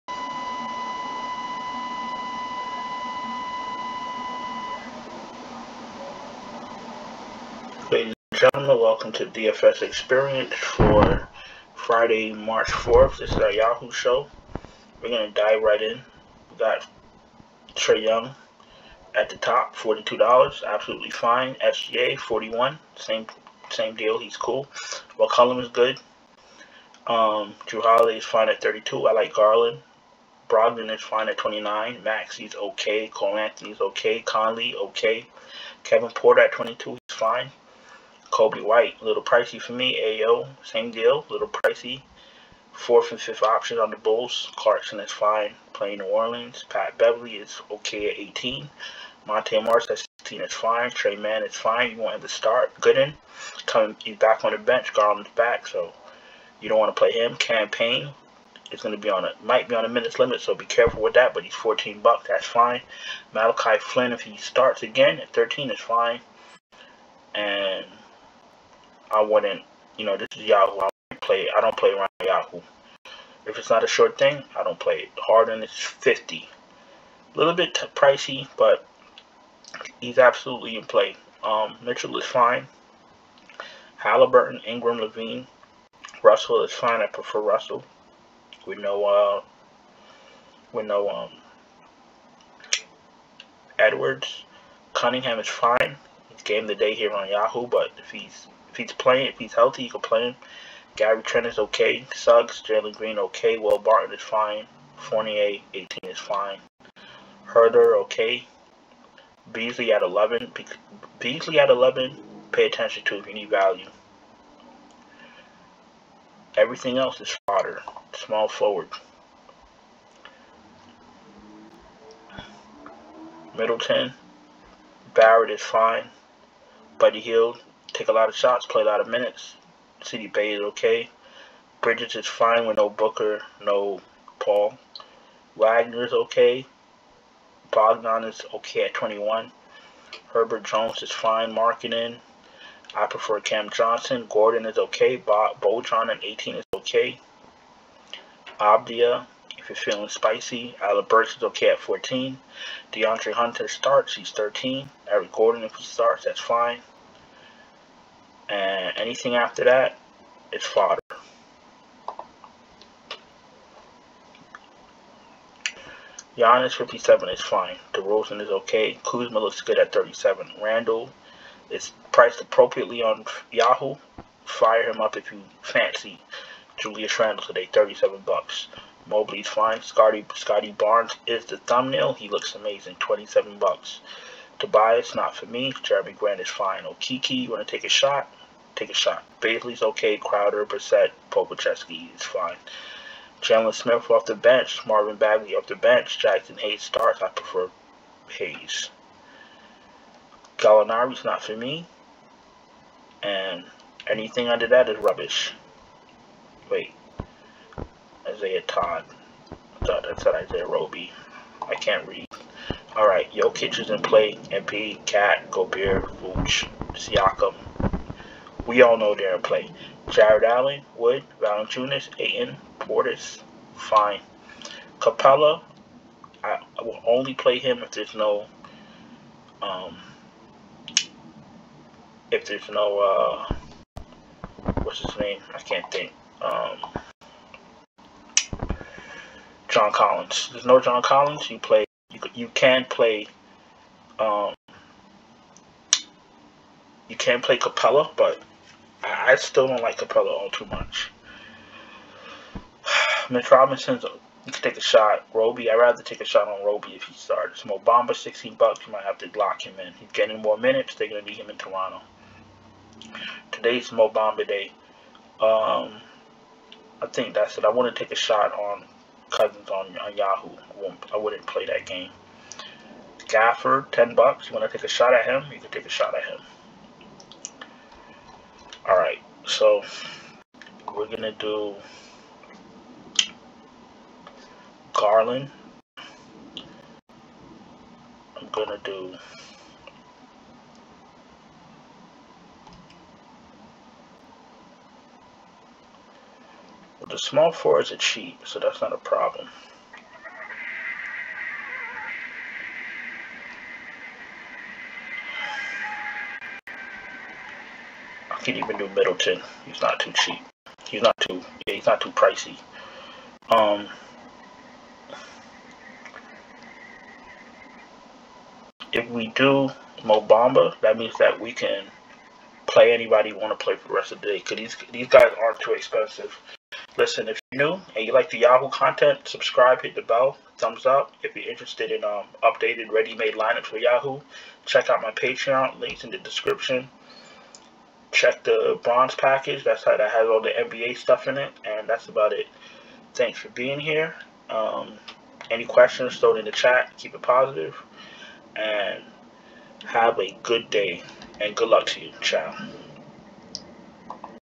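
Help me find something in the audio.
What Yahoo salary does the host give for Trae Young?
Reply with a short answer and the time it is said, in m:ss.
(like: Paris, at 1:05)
$42, at 0:19.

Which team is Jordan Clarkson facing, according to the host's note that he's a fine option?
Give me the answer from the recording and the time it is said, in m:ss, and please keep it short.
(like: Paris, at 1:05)
New Orleans, at 0:45.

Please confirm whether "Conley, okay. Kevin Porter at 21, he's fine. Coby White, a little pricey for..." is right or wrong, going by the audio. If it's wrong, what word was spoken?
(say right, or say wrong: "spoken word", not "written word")
wrong: "22", not "21".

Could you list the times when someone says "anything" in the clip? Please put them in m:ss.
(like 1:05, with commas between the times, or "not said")
2:38, 3:24.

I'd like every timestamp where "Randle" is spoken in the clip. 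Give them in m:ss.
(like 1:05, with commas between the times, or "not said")
2:50, 2:57.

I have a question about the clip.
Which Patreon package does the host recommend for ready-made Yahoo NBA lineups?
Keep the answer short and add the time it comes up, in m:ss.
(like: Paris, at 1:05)
bronze package, at 5:38.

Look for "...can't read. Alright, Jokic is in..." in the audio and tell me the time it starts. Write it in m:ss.
3:31.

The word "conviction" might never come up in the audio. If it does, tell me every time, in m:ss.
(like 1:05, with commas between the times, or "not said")
not said.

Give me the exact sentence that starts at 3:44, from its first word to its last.
Capela, I, will only play him if there's no, um, if there's no, uh, what's his name?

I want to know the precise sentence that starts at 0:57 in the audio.
Campaign is going to be on a might be on a minutes limit, so be careful with that.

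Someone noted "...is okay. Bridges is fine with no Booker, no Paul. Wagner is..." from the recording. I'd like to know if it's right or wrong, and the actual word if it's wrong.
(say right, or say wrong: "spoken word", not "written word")
right.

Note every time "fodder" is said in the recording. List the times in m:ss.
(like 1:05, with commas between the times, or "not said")
1:57, 2:40.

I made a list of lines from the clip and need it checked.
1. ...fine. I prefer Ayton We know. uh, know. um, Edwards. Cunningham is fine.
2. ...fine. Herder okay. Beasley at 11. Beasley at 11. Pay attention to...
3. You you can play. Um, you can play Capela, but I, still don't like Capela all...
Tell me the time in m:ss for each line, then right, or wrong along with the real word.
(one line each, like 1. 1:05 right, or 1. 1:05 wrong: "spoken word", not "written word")
1. 1:26 wrong: "Russell", not "Ayton"
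2. 1:46 right
3. 4:02 right.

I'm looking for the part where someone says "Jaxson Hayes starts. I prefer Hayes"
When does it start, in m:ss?
3:16.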